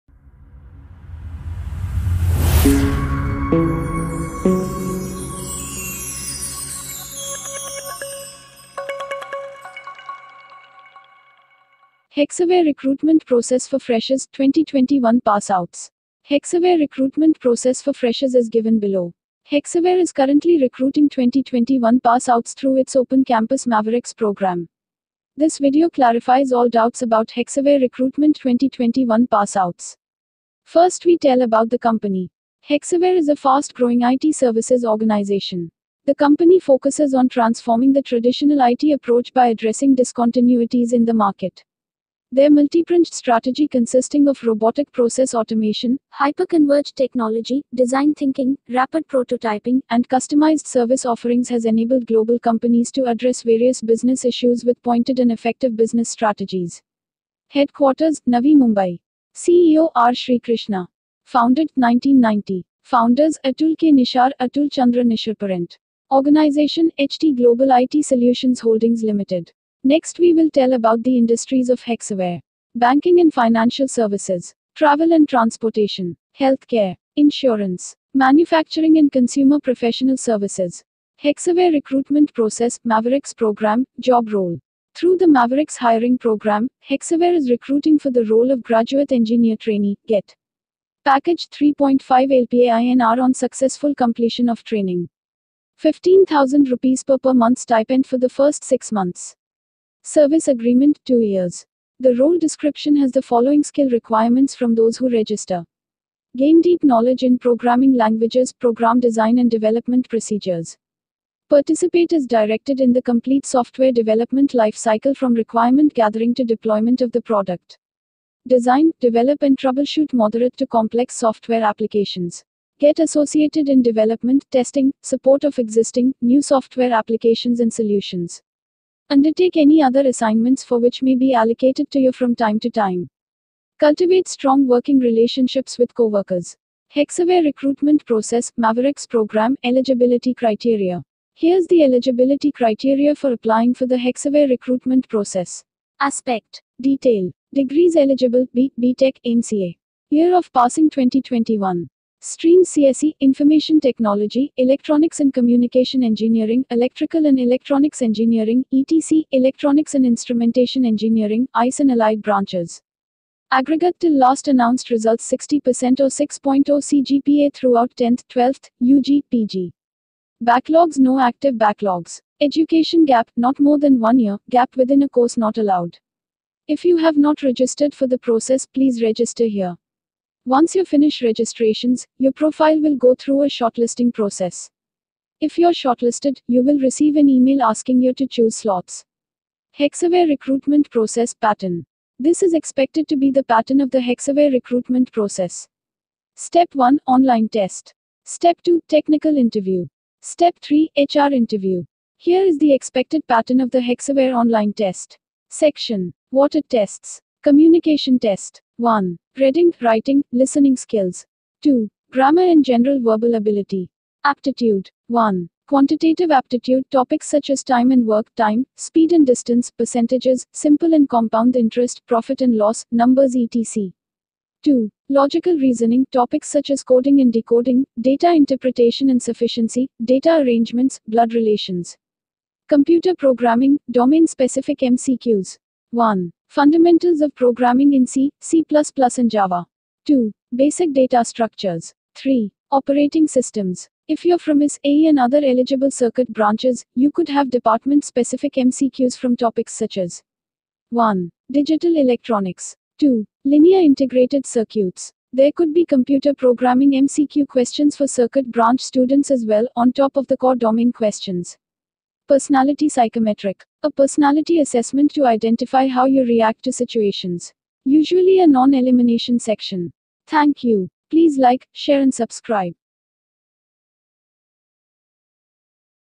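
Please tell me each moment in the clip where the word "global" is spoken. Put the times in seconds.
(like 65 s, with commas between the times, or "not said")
52 s, 67 s.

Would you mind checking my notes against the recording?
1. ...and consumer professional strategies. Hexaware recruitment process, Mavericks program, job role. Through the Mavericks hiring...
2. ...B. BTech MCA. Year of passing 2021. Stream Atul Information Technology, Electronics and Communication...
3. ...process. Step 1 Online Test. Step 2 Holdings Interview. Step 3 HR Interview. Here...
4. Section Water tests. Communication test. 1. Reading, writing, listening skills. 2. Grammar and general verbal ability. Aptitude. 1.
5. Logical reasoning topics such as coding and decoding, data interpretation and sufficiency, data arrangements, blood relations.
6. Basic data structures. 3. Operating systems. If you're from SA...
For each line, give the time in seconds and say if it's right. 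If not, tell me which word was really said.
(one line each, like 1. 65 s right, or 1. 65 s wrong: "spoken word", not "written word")
1. 78 s wrong: "services", not "strategies"
2. 148 s wrong: "CSE", not "Atul"
3. 195 s wrong: "Technical", not "Holdings"
4. 205 s right
5. 225 s right
6. 240 s right.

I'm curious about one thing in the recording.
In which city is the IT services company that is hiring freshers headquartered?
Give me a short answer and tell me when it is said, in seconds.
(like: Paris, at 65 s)
Navi Mumbai, at 58 s.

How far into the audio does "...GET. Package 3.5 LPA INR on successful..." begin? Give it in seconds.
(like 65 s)
90 s.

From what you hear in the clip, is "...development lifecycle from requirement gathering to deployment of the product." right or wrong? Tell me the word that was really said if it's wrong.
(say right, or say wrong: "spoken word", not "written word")
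right.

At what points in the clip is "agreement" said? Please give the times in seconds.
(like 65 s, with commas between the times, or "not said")
100 s.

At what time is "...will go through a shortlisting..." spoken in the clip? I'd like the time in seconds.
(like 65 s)
182 s.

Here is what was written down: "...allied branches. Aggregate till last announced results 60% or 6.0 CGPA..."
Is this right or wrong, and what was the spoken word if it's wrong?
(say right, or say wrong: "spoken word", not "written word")
right.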